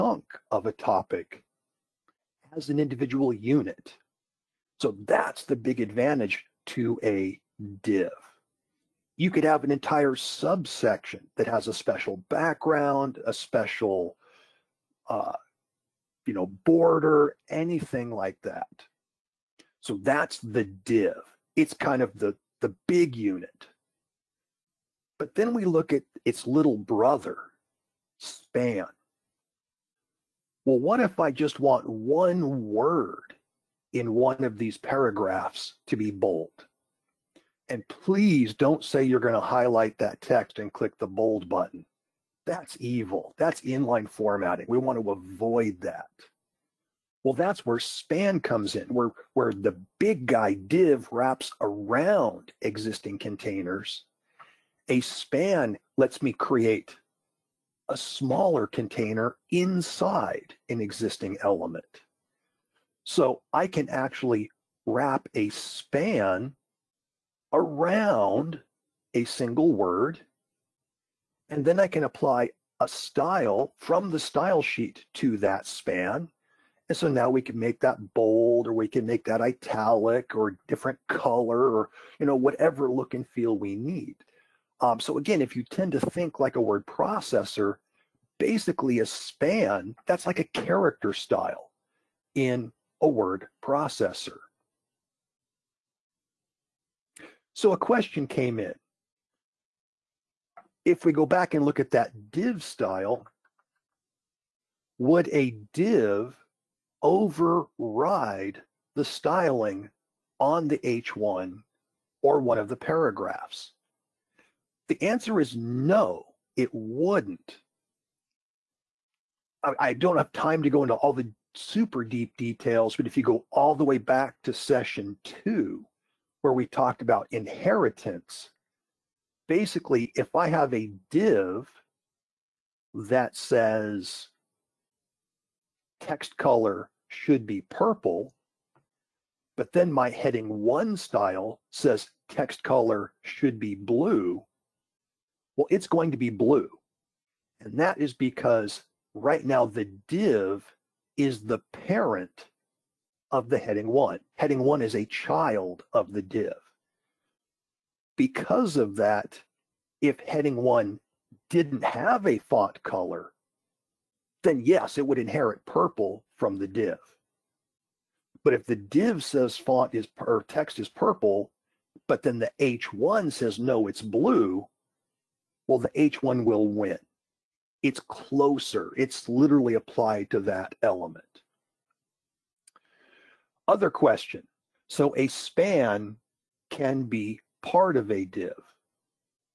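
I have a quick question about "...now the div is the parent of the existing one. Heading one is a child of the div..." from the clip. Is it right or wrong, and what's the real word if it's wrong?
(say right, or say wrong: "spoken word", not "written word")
wrong: "heading", not "existing".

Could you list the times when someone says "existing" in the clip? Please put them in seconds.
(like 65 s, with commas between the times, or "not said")
52 s, 60 s.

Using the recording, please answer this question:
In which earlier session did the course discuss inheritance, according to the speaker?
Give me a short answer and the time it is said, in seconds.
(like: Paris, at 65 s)
session 2, at 124 s.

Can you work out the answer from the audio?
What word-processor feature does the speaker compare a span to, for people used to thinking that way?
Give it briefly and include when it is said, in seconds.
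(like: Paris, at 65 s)
character style, at 90 s.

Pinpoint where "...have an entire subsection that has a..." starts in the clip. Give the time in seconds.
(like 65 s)
9 s.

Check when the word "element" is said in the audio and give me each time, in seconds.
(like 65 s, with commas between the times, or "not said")
61 s, 180 s.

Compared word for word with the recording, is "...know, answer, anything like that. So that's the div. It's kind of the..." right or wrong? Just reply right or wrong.
wrong.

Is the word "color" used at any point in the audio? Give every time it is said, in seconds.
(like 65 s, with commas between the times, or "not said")
81 s, 136 s, 142 s, 162 s.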